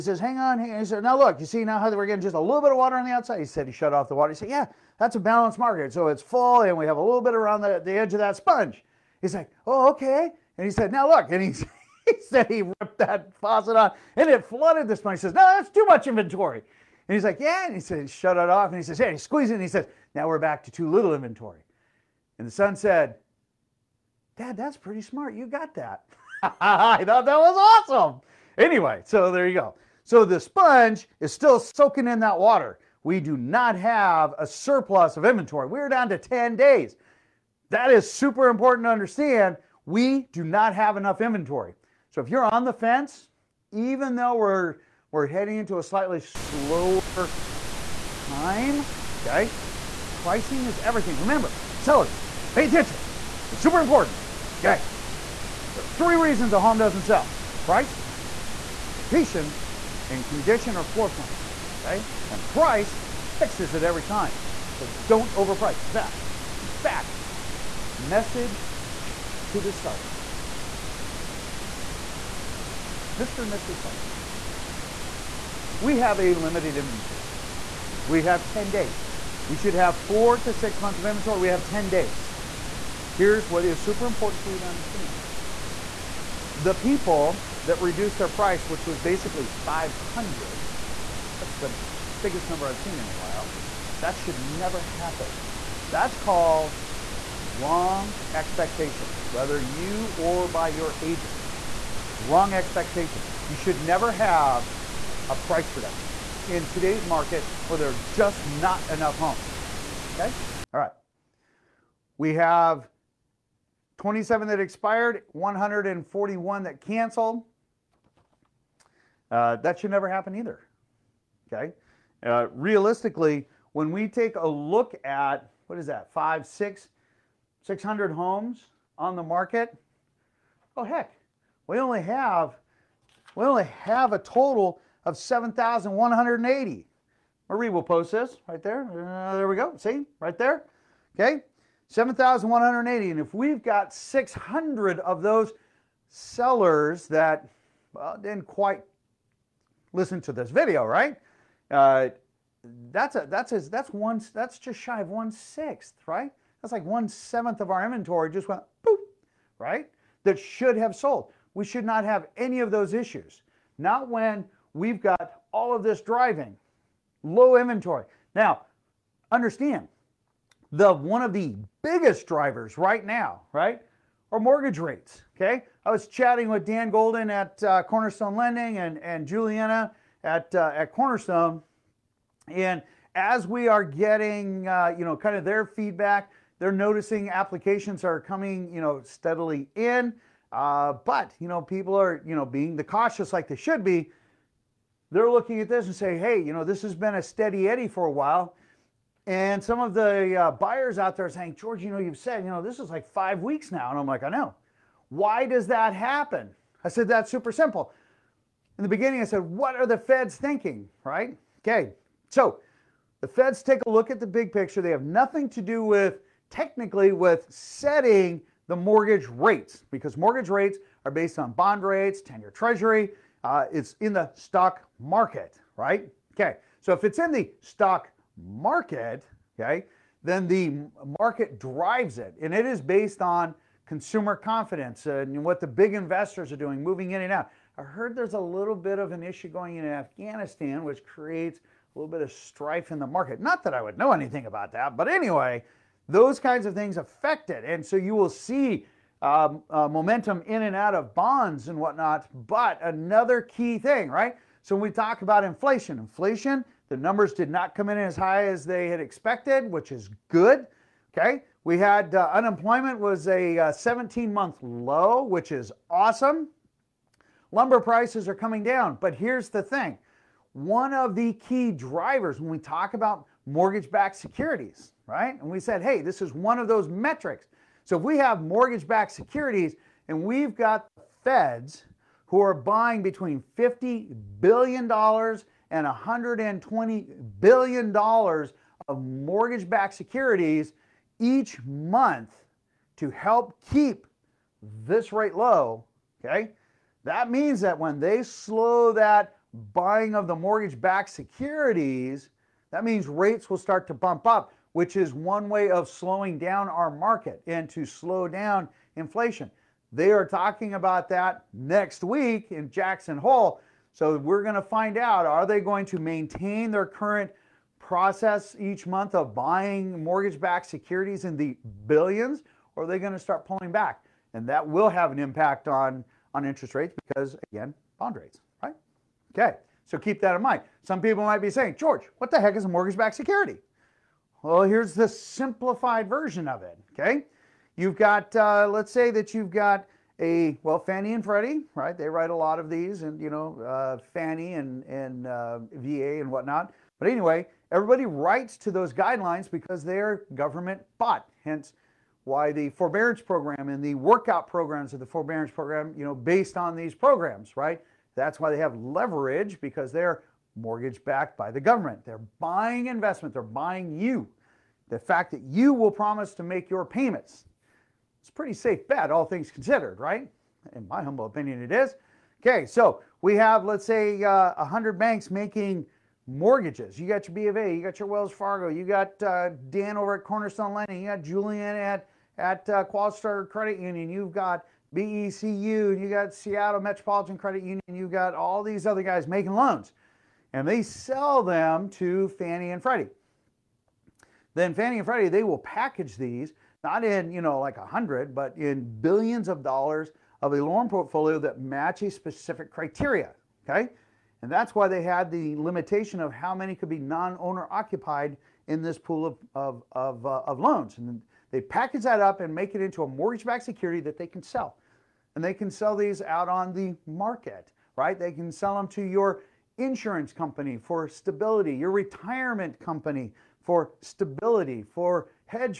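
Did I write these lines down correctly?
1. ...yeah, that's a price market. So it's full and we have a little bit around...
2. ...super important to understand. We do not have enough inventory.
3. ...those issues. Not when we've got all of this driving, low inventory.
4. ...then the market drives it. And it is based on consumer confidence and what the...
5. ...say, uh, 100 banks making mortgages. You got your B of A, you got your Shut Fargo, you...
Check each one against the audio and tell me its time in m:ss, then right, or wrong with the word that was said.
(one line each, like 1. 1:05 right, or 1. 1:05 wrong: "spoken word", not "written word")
1. 0:04 wrong: "balance", not "price"
2. 0:38 right
3. 2:42 right
4. 3:50 right
5. 6:13 wrong: "Wells", not "Shut".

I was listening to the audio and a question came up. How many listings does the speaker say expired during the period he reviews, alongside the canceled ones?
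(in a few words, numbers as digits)
27.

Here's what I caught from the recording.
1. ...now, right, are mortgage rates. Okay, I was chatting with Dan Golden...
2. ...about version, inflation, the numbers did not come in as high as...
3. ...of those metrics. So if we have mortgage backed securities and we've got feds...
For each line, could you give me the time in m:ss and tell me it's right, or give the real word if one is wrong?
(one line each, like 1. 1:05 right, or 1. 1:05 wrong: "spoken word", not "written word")
1. 2:53 right
2. 4:15 wrong: "inflation", not "version"
3. 4:36 right.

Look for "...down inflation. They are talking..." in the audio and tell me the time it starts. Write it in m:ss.
5:08.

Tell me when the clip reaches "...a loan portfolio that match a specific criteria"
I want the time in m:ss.
6:40.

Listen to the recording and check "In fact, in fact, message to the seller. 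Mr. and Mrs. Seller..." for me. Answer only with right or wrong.
right.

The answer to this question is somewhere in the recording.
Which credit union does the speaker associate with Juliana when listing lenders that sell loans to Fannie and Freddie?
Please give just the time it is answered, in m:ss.
6:22.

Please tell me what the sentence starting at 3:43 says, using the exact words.
Uh, it's in the stock market, right?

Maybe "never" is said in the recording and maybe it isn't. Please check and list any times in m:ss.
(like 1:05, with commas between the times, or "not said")
1:34, 1:43, 1:59.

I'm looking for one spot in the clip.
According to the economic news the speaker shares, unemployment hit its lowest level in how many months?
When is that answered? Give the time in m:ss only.
4:23.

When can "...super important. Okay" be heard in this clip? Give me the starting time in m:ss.
0:53.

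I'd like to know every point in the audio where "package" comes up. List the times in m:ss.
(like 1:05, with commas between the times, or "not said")
6:35, 6:51.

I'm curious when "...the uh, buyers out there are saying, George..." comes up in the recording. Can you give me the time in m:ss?
3:19.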